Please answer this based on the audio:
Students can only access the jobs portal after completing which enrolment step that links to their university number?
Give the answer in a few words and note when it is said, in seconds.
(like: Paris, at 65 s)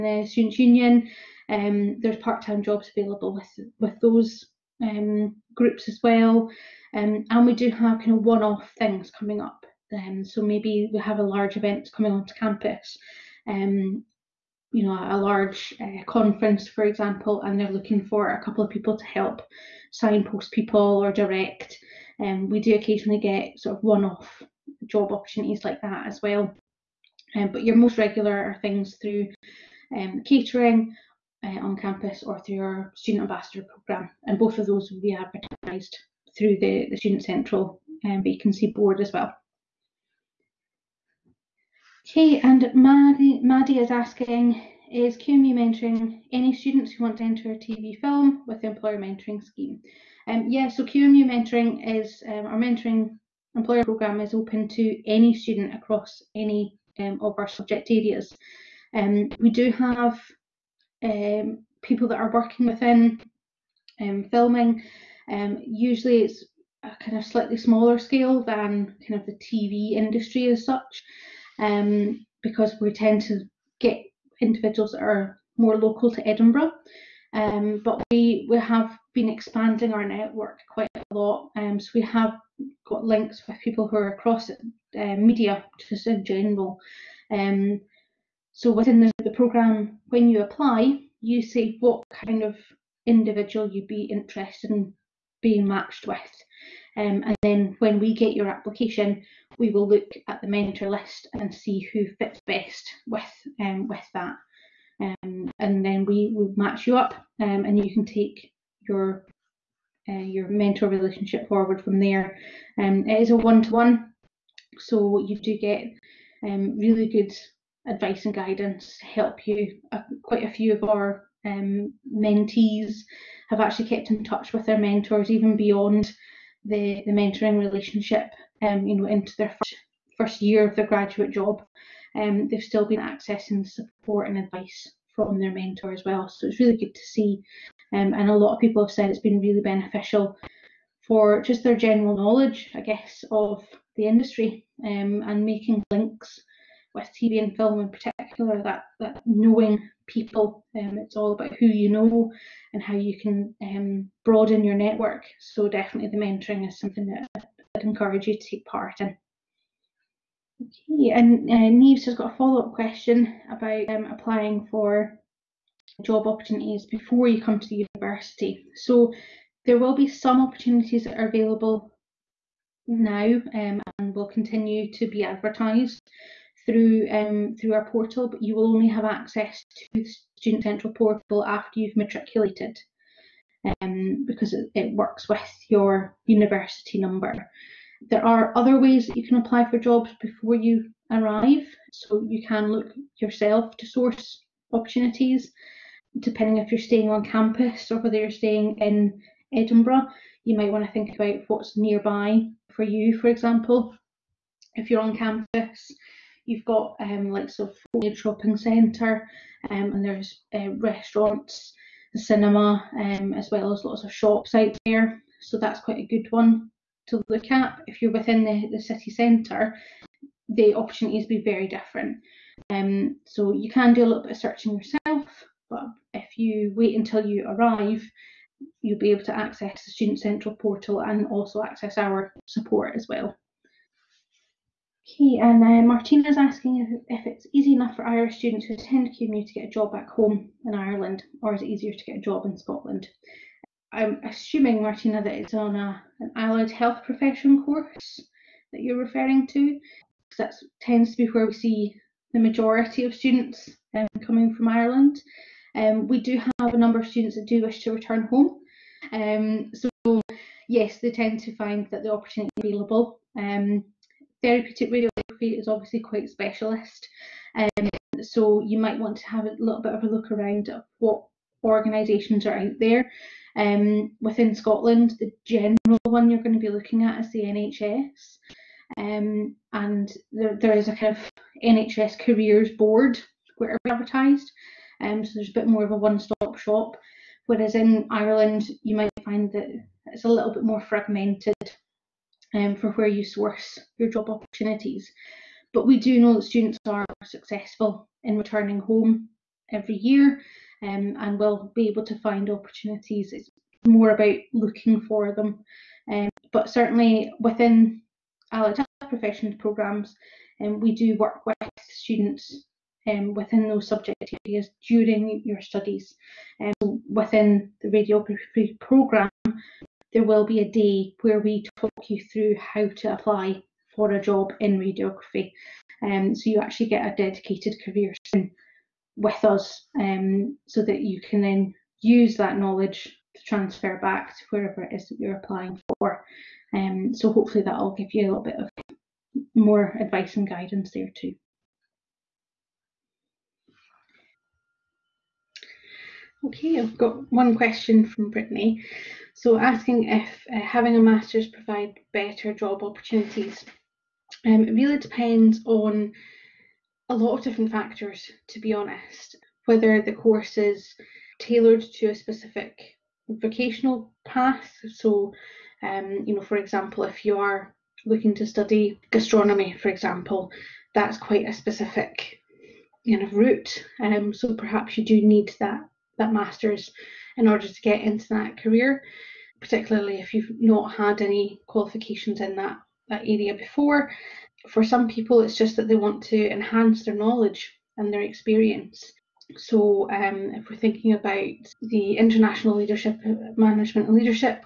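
matriculated, at 181 s.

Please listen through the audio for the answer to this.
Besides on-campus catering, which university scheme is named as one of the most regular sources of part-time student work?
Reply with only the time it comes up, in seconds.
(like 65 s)
32 s.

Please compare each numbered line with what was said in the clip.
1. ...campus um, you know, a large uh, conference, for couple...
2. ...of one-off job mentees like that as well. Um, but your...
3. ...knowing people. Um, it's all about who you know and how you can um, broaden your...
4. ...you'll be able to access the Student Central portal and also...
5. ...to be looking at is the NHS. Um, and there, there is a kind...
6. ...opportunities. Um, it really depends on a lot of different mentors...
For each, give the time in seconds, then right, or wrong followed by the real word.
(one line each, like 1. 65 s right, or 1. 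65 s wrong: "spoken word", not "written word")
1. 12 s wrong: "example", not "couple"
2. 23 s wrong: "opportunities", not "mentees"
3. 149 s right
4. 228 s right
5. 276 s right
6. 352 s wrong: "factors", not "mentors".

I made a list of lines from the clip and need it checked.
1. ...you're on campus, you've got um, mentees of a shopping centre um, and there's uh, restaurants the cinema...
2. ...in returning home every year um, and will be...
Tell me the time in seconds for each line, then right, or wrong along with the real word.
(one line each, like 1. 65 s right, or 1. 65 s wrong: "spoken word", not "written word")
1. 204 s wrong: "likes", not "mentees"
2. 298 s right.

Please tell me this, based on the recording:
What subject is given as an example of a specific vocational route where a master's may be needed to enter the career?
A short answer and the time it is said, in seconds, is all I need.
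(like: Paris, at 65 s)
gastronomy, at 369 s.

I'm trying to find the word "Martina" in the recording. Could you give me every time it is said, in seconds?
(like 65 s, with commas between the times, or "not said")
235 s, 244 s.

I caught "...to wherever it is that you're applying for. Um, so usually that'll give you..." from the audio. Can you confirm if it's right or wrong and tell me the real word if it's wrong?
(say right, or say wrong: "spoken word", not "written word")
wrong: "hopefully", not "usually".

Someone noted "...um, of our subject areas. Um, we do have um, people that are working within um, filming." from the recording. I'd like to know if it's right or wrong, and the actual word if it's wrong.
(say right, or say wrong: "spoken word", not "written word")
right.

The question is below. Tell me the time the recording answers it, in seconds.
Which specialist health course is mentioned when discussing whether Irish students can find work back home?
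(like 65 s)
264 s.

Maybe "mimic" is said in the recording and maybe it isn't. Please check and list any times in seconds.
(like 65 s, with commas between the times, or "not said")
not said.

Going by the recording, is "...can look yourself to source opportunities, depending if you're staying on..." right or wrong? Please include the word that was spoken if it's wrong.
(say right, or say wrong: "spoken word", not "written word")
right.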